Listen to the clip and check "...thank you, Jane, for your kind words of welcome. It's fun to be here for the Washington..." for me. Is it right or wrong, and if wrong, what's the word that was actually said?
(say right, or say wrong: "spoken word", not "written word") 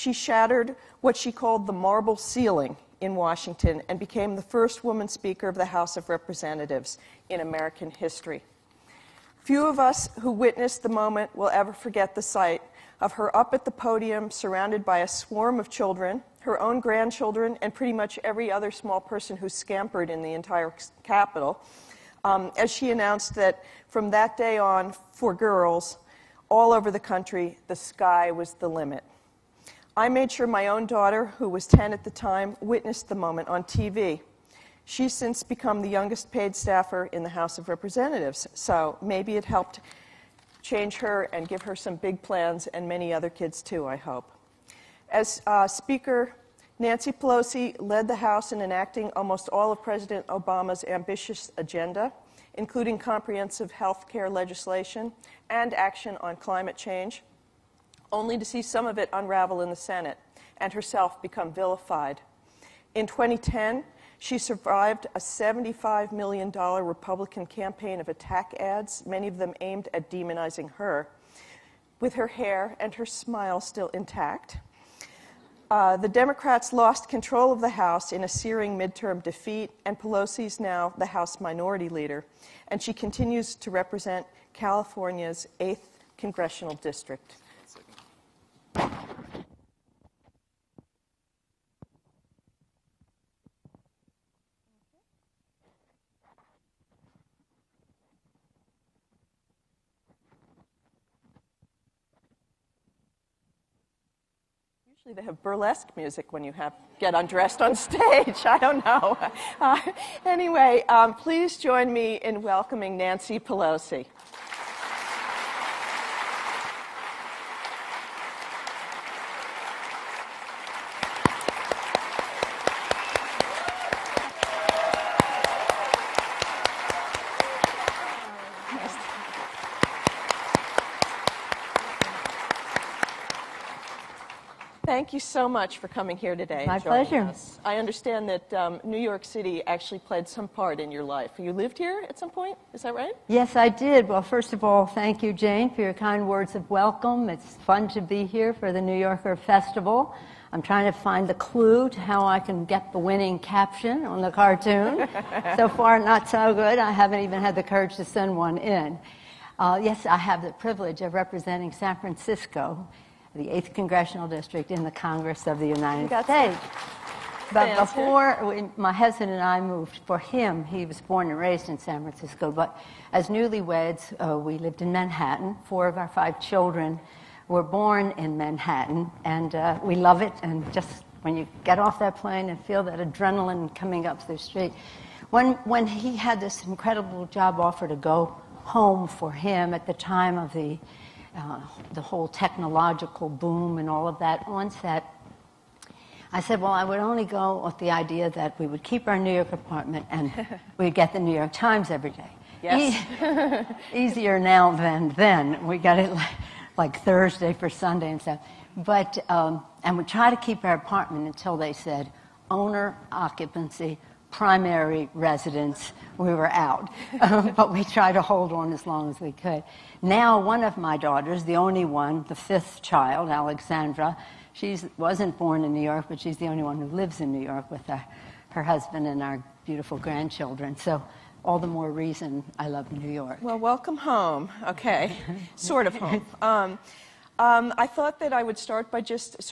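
wrong: "New", not "Washington".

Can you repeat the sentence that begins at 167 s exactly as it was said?
But before we, my husband and I moved, for him, he was born and raised in San Francisco.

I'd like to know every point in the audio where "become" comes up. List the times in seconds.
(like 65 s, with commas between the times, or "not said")
35 s, 61 s.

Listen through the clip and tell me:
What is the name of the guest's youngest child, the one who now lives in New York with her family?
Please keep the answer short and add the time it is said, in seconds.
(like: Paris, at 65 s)
Alexandra, at 223 s.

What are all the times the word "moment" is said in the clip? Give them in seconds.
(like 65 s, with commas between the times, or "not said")
10 s, 33 s.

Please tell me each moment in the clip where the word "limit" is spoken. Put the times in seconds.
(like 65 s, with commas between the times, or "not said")
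28 s.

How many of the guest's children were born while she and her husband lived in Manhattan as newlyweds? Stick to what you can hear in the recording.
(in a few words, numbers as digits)
4.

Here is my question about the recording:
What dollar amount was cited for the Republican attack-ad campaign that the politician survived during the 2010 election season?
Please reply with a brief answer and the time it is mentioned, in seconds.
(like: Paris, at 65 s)
$75 million, at 65 s.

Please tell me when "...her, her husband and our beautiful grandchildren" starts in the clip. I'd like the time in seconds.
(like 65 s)
227 s.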